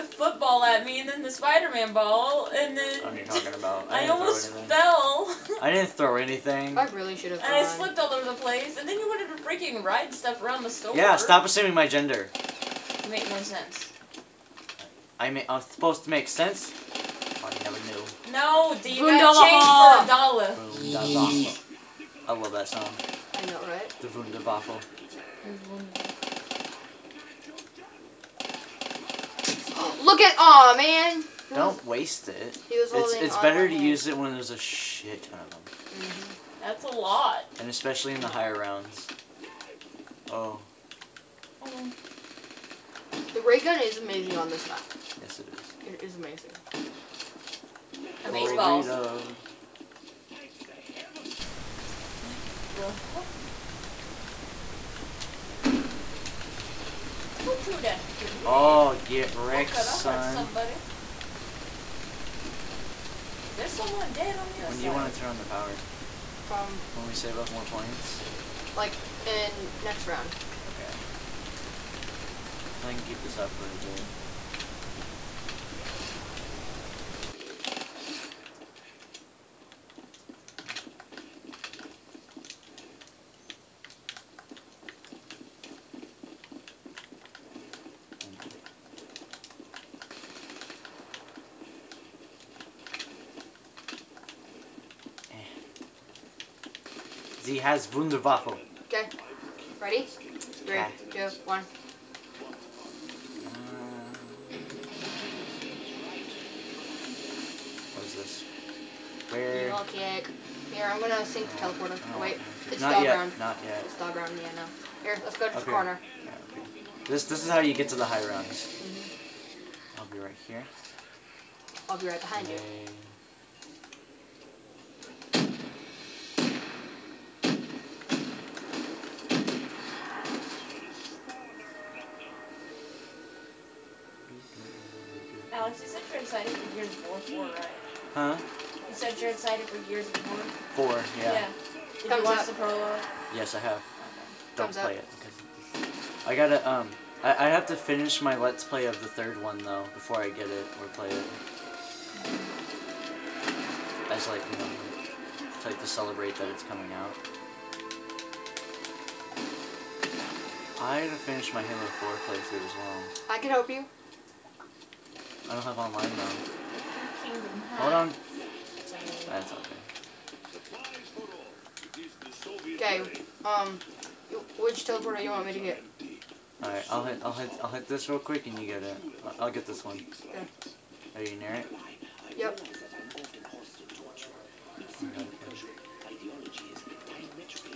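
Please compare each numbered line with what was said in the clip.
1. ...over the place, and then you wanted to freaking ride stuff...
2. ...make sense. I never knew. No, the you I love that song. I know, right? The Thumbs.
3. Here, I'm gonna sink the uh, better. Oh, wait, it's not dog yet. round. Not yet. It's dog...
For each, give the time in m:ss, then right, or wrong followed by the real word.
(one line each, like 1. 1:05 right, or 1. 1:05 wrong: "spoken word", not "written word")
1. 0:08 right
2. 0:16 wrong: "Wunderwaffel", not "Thumbs"
3. 1:50 wrong: "teleporter", not "better".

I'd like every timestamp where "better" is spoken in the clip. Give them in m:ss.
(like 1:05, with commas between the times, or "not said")
0:33.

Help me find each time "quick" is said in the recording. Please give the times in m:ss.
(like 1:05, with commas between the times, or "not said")
2:58.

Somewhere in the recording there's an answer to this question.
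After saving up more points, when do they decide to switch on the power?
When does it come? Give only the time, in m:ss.
1:09.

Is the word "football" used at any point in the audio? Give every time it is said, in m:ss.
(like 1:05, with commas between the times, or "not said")
0:00.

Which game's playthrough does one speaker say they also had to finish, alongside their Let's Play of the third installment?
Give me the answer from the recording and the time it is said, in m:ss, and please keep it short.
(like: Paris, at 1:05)
Halo 4, at 2:41.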